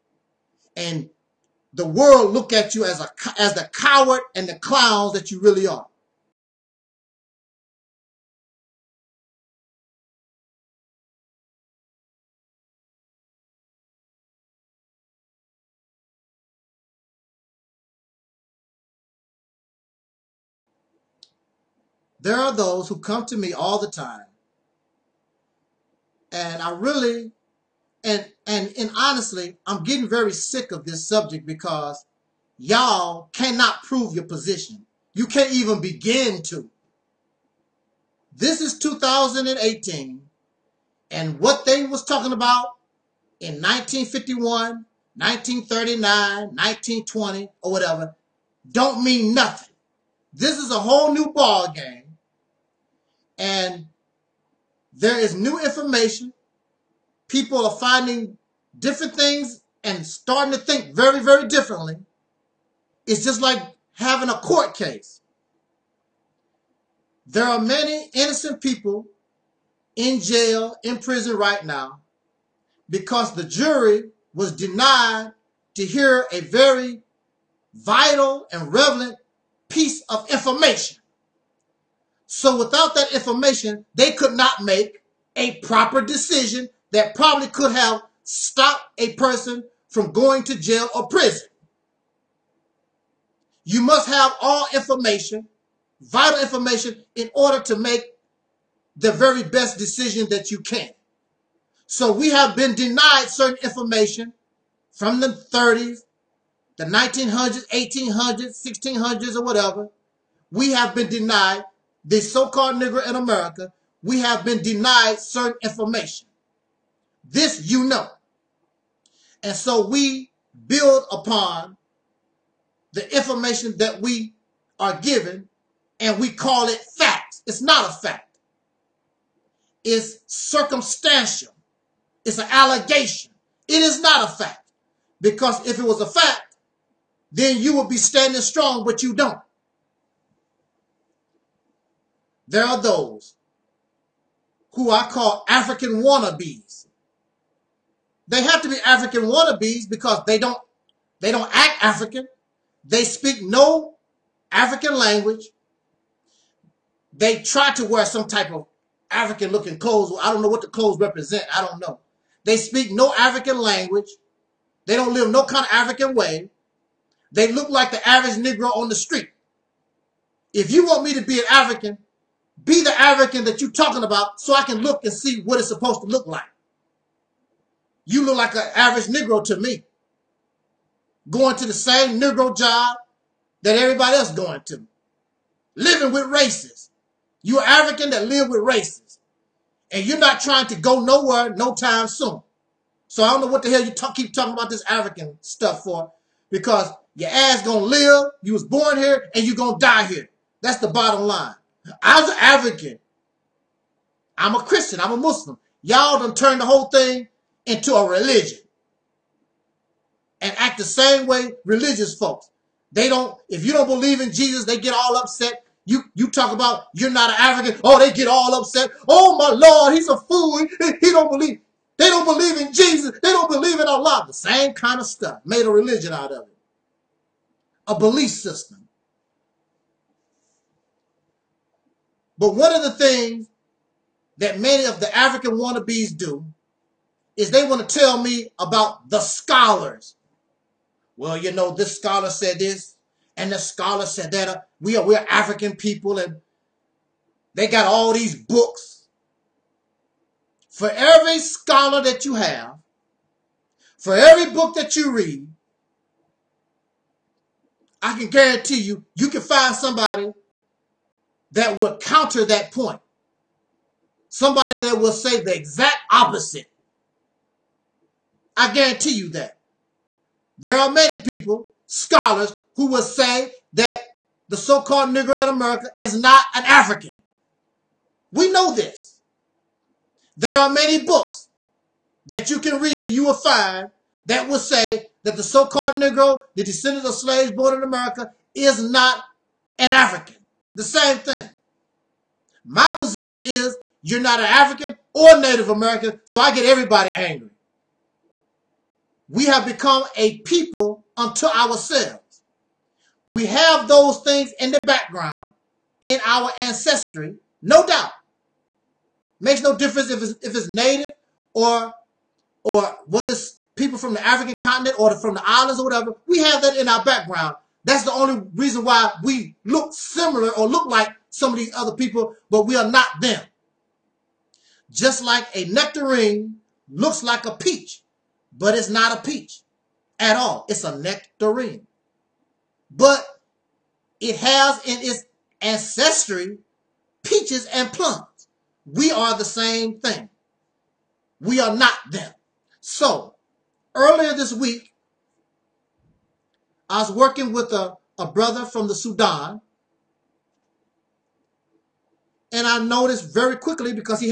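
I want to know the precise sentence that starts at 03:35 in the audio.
You, you talk about you're not an African.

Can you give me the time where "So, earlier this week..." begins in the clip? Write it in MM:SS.
05:42.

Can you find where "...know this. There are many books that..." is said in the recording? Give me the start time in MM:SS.
04:38.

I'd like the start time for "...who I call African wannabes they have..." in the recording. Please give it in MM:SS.
02:24.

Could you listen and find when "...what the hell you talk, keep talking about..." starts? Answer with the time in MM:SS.
03:13.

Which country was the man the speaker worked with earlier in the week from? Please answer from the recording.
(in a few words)
Sudan.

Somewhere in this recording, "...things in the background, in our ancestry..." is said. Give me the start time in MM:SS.
05:04.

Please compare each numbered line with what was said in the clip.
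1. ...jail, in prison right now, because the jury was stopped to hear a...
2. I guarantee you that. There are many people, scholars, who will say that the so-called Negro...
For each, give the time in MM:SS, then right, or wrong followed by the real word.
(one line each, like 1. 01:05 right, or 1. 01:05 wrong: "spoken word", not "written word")
1. 01:10 wrong: "denied", not "stopped"
2. 04:28 right.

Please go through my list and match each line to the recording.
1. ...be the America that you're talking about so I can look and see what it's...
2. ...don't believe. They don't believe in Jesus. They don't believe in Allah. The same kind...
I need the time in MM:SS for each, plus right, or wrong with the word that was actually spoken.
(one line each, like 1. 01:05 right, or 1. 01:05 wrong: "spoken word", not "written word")
1. 02:52 wrong: "African", not "America"
2. 03:41 right.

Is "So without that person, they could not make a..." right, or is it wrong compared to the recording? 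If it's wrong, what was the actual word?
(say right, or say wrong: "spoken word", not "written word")
wrong: "information", not "person".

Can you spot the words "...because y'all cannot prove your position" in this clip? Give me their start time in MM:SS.
00:31.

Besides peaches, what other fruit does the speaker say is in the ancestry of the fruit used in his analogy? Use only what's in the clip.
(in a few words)
Plums.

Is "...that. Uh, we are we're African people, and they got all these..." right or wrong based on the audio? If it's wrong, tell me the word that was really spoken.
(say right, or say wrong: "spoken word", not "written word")
right.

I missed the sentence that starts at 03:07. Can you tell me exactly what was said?
you African that live with racists.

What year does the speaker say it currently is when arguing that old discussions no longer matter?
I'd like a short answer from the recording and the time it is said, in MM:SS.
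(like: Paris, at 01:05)
2018, at 00:38.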